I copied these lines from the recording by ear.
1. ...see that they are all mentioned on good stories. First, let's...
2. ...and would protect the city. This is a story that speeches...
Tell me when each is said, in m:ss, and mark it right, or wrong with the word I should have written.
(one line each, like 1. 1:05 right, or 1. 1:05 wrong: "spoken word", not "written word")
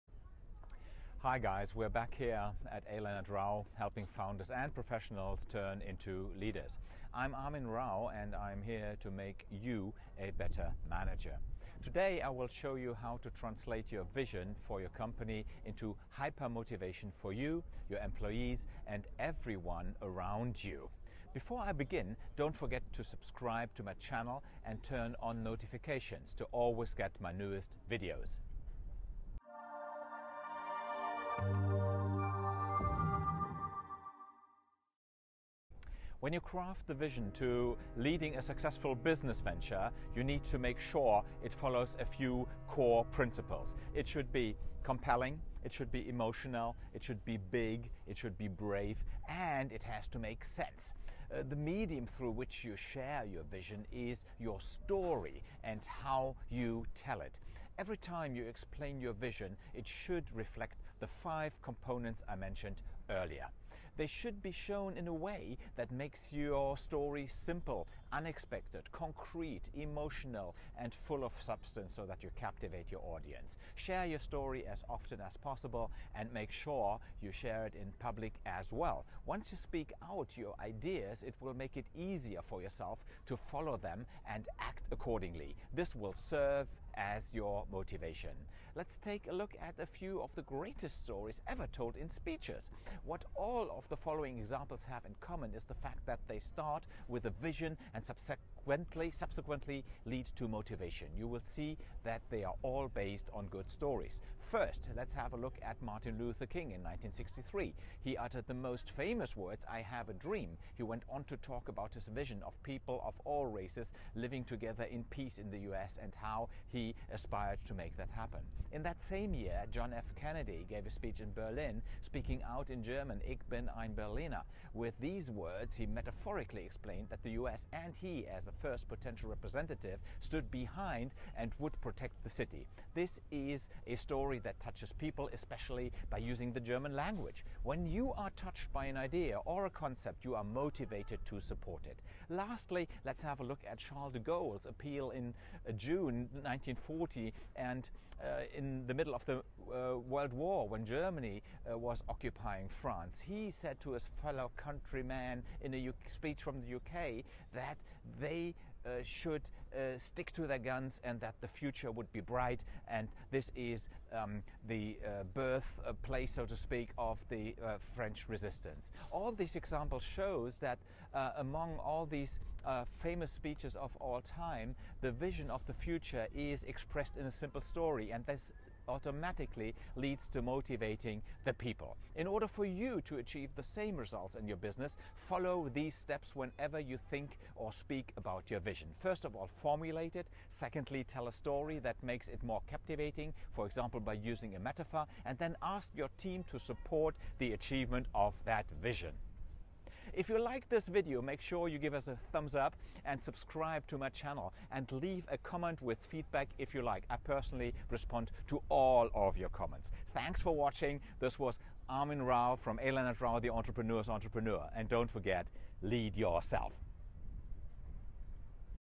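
1. 1:41 wrong: "based", not "mentioned"
2. 2:11 wrong: "touches", not "speeches".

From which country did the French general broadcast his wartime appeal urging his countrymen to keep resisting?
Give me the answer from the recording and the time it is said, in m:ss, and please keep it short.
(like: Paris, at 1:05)
The UK, at 2:36.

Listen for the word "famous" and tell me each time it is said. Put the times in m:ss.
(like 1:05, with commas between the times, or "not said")
1:48, 2:53.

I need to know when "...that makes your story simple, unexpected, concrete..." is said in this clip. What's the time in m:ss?
1:05.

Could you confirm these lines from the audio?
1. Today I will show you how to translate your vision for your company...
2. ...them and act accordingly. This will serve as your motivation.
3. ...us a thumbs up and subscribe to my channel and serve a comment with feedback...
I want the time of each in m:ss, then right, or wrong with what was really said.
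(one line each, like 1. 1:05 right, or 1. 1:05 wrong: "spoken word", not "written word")
1. 0:11 right
2. 1:23 right
3. 3:21 wrong: "leave", not "serve".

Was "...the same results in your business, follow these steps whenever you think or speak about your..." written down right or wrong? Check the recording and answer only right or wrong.
right.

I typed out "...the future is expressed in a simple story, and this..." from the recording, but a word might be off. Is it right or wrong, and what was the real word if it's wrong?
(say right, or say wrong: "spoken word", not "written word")
right.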